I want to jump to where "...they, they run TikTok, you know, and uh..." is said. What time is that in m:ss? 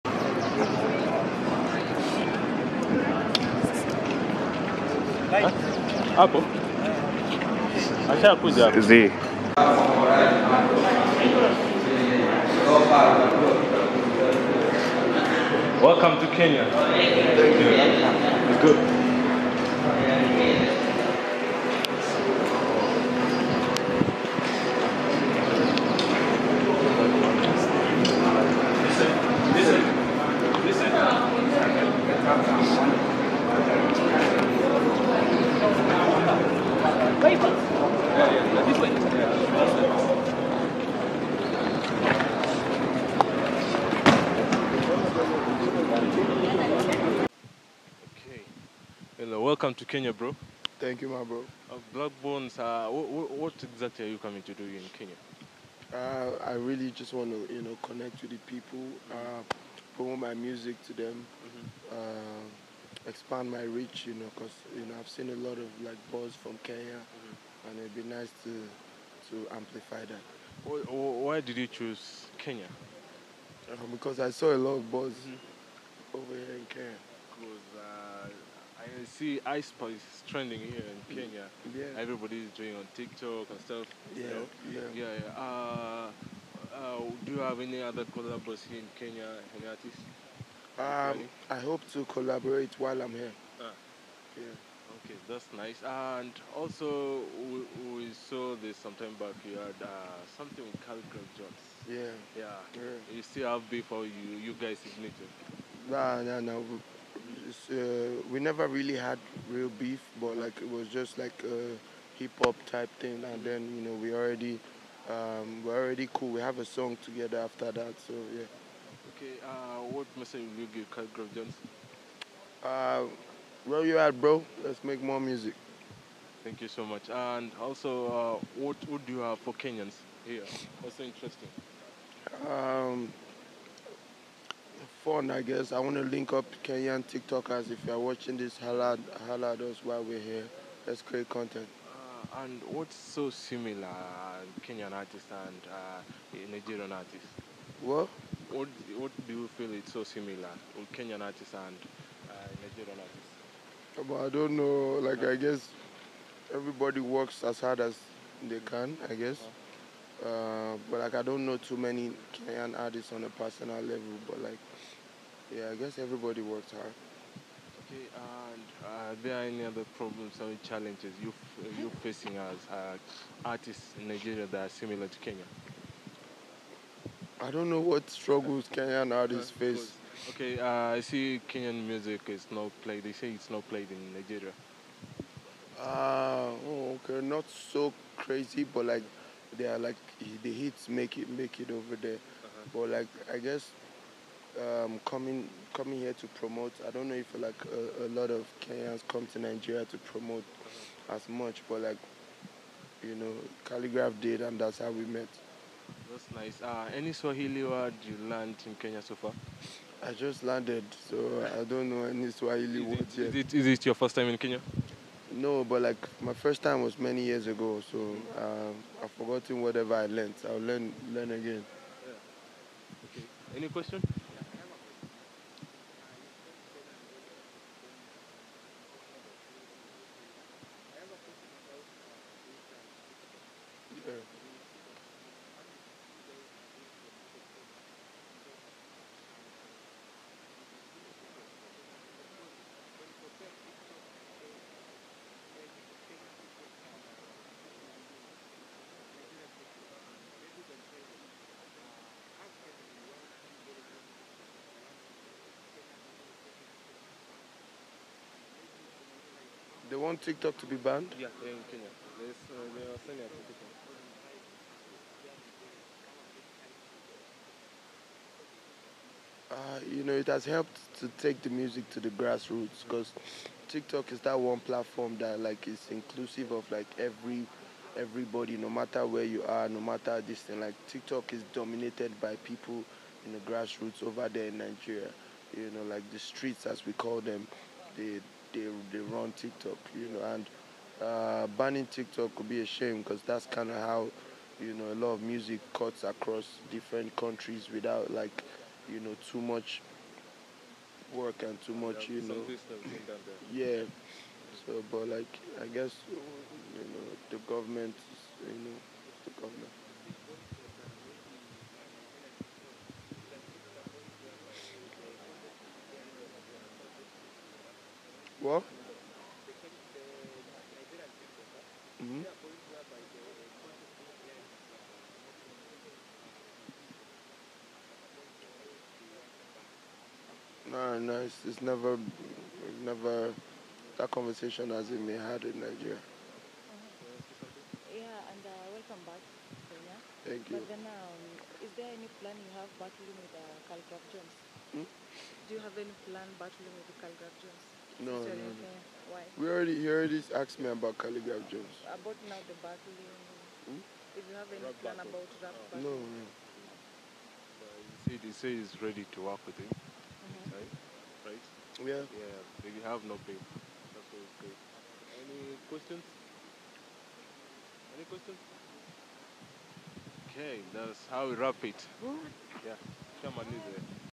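4:48.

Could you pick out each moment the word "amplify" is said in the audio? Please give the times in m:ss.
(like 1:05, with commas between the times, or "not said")
1:09.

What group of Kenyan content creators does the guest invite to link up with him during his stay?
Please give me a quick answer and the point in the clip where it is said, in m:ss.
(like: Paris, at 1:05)
Kenyan TikTokers, at 2:16.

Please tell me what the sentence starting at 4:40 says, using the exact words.
Like TikTok is dominated by people in the grassroots over there in Nigeria.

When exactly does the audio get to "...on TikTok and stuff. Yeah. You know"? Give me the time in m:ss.
1:22.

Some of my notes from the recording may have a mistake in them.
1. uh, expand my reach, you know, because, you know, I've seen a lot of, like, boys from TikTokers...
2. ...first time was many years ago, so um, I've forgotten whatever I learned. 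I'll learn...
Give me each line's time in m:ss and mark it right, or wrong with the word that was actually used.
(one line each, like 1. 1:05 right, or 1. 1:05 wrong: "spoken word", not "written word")
1. 1:01 wrong: "Kenya", not "TikTokers"
2. 3:36 right.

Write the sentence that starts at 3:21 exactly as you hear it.
as much, but like you know, Khaligraph did, and that's how we met.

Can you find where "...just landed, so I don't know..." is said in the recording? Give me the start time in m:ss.
3:30.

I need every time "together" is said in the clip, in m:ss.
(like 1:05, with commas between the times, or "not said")
1:57.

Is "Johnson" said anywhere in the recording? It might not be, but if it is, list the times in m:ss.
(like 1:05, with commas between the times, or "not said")
2:01.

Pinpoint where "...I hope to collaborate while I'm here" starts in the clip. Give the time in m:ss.
1:31.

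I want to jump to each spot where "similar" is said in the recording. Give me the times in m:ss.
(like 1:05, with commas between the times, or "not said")
2:23, 2:30, 2:54.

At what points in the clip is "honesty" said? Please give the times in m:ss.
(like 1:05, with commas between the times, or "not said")
not said.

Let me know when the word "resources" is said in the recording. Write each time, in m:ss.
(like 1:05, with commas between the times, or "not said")
not said.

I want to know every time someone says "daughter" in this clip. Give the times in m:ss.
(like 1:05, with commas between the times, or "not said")
not said.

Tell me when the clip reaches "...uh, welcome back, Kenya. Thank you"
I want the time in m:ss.
5:38.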